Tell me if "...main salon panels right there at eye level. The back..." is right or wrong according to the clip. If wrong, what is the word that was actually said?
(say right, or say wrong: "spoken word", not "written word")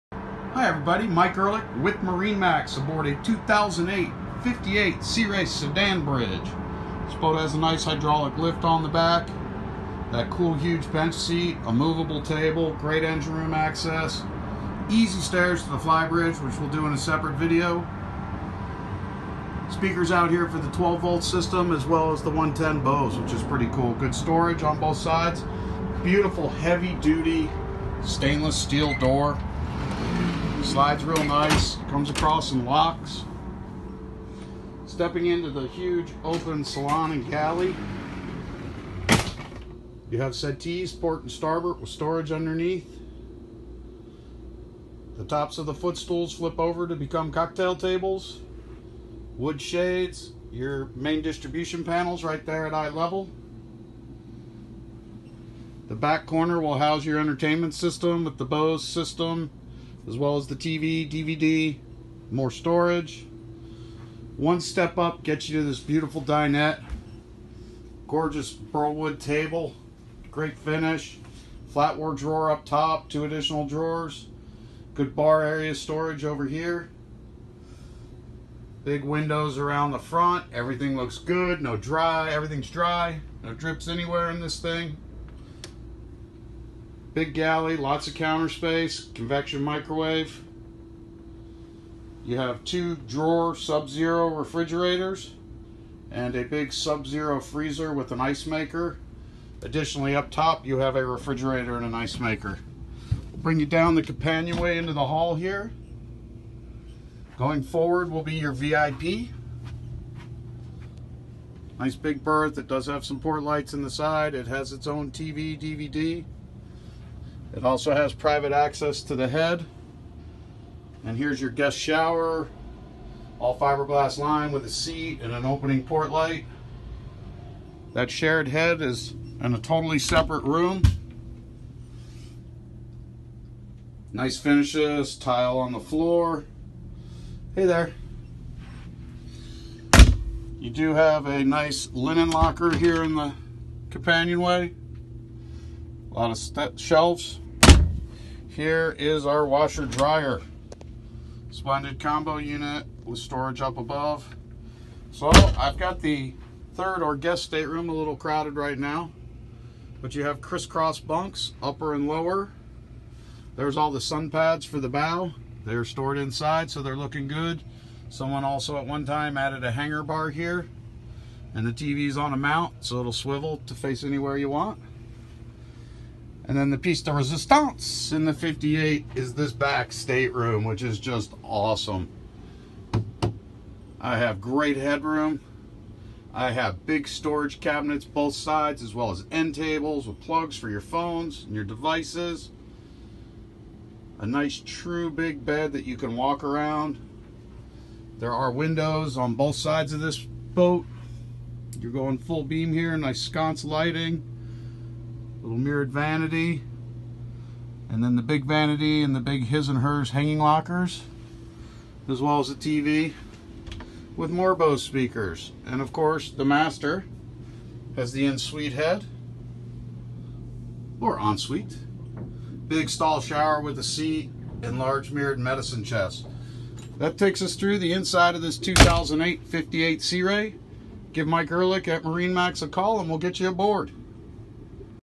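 wrong: "distribution", not "salon".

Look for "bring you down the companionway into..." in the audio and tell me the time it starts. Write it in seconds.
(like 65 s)
103 s.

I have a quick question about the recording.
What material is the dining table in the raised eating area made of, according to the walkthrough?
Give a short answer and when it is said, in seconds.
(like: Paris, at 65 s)
Burlwood, at 68 s.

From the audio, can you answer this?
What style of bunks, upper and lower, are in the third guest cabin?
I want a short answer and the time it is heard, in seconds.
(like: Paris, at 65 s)
Crisscross bunks, at 160 s.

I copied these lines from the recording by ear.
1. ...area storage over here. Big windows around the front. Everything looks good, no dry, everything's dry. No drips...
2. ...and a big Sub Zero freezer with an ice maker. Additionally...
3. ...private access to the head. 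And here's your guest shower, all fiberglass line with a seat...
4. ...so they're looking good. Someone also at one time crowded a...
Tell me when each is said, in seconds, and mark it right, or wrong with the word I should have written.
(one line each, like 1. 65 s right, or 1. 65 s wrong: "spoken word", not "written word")
1. 75 s right
2. 96 s right
3. 118 s right
4. 166 s wrong: "added", not "crowded".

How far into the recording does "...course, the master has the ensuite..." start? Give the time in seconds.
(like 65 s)
215 s.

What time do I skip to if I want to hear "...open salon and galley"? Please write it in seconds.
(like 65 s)
36 s.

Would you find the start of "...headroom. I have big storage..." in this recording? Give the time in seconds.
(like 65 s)
184 s.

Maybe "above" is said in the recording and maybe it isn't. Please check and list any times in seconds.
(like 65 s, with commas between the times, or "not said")
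153 s.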